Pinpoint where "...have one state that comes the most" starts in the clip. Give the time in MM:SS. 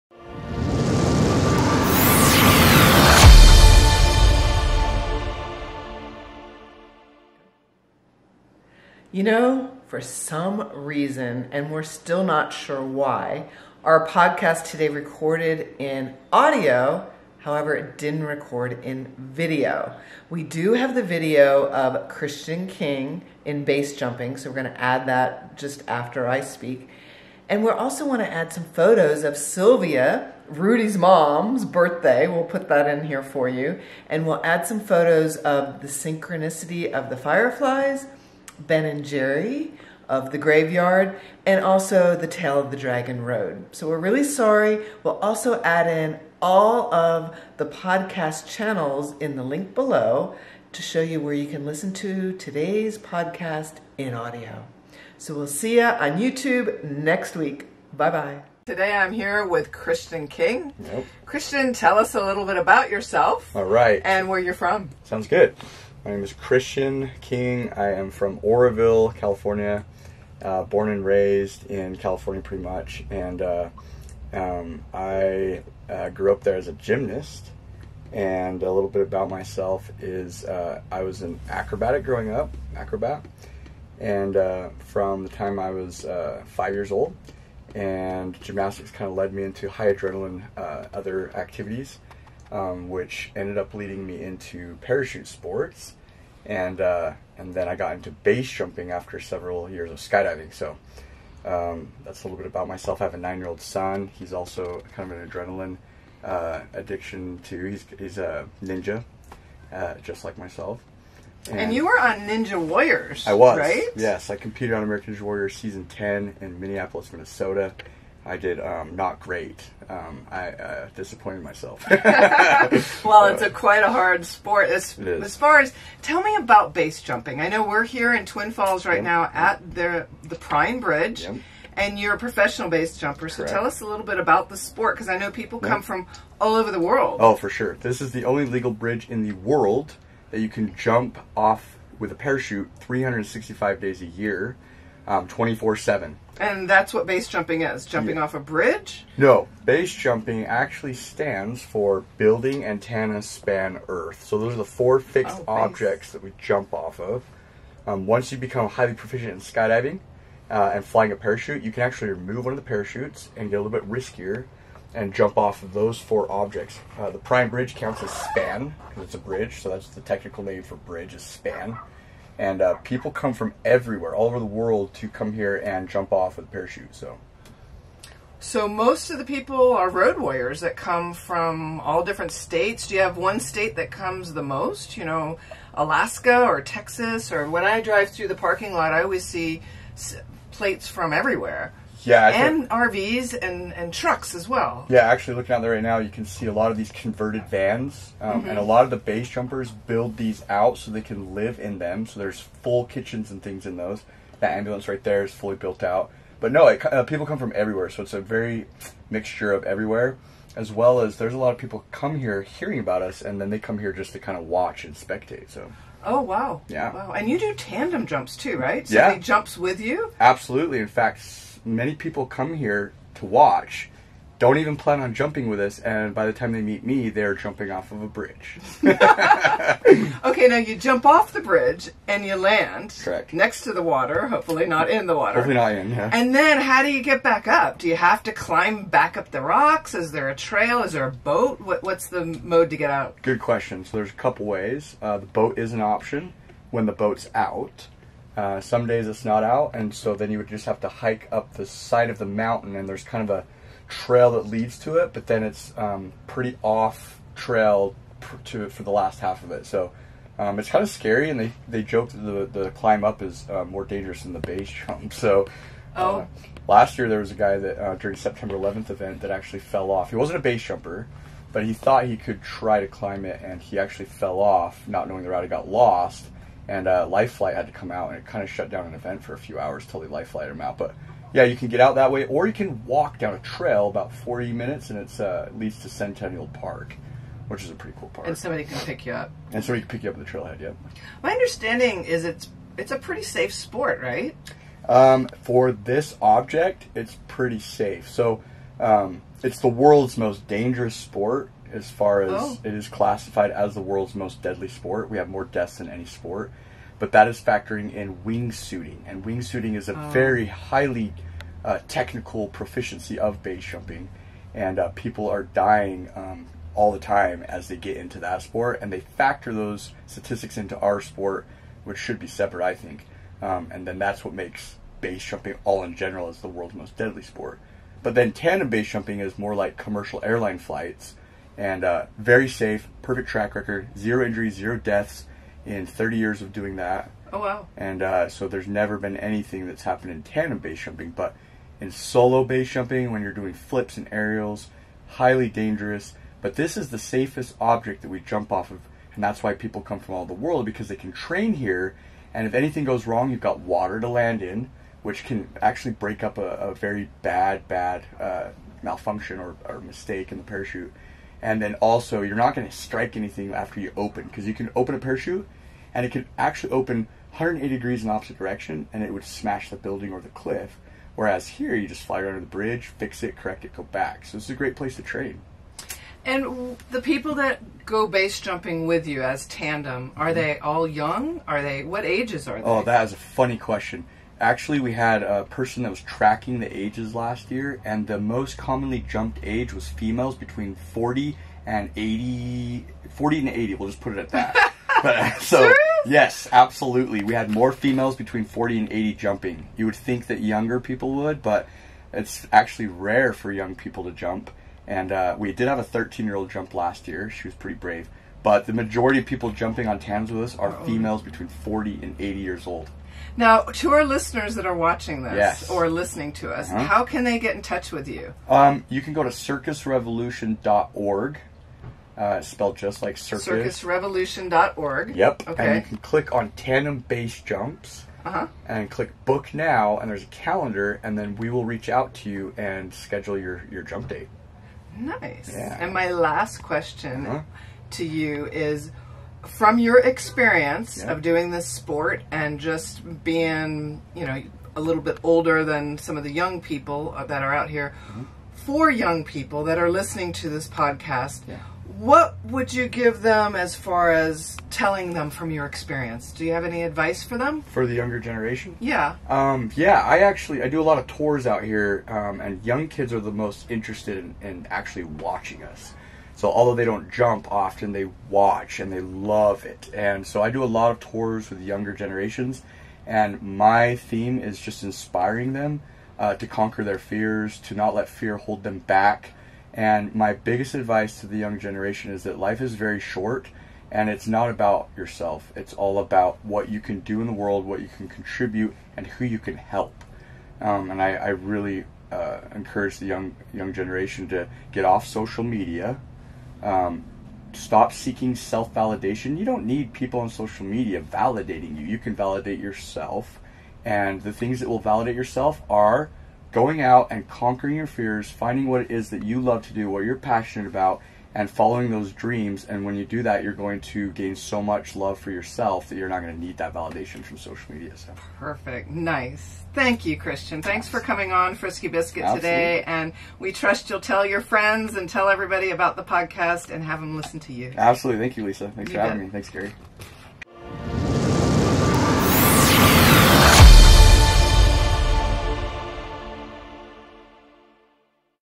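03:03.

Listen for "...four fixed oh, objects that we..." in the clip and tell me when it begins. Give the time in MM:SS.
02:34.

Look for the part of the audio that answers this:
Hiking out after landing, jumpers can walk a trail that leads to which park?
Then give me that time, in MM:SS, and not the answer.
04:45.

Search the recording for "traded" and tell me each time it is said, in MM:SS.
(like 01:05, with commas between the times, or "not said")
not said.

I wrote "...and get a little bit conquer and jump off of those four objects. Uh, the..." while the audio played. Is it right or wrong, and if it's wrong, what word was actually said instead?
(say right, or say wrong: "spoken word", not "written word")
wrong: "riskier", not "conquer".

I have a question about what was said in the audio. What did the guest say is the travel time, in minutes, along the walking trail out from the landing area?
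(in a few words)
40 minutes.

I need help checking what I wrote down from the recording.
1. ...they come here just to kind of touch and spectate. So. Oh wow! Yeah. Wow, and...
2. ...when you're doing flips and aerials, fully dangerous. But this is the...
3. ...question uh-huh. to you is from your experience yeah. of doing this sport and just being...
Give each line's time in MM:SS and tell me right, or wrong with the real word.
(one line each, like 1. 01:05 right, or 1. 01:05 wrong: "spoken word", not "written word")
1. 03:33 wrong: "watch", not "touch"
2. 05:43 wrong: "highly", not "fully"
3. 07:16 right.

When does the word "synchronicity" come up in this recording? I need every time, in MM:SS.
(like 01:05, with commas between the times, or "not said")
00:35.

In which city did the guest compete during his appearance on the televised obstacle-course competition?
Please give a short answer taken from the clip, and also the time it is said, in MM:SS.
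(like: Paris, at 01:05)
Minneapolis, at 01:56.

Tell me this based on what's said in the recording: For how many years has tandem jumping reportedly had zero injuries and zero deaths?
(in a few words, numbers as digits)
30.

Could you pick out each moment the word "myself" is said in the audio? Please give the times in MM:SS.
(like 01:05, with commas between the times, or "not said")
01:19, 01:42, 01:50, 02:01.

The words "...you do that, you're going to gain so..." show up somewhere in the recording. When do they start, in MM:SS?
08:32.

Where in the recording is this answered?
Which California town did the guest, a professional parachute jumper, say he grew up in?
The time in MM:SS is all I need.
01:08.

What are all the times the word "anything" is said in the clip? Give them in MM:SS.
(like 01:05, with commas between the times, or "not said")
05:39, 05:52, 06:03.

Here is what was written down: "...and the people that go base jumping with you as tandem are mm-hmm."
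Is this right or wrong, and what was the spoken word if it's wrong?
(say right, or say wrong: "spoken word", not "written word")
right.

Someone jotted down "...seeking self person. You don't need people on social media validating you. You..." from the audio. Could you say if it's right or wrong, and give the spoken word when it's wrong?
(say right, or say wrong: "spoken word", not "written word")
wrong: "validation", not "person".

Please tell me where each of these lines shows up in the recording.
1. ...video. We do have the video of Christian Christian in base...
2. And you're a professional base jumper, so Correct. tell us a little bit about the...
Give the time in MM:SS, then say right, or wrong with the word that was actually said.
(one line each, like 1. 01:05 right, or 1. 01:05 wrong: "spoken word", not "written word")
1. 00:19 wrong: "King", not "Christian"
2. 02:11 right.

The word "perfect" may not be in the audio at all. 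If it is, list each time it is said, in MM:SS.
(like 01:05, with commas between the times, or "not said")
05:33, 08:38.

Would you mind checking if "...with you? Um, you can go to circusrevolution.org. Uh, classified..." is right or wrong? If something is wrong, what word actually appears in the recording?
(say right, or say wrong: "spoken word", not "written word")
wrong: "spelled", not "classified".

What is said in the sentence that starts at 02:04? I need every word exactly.
As, as, far as tell me about base jumping.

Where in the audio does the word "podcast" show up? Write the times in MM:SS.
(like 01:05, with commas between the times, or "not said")
00:14, 00:47, 00:52, 07:30, 08:46.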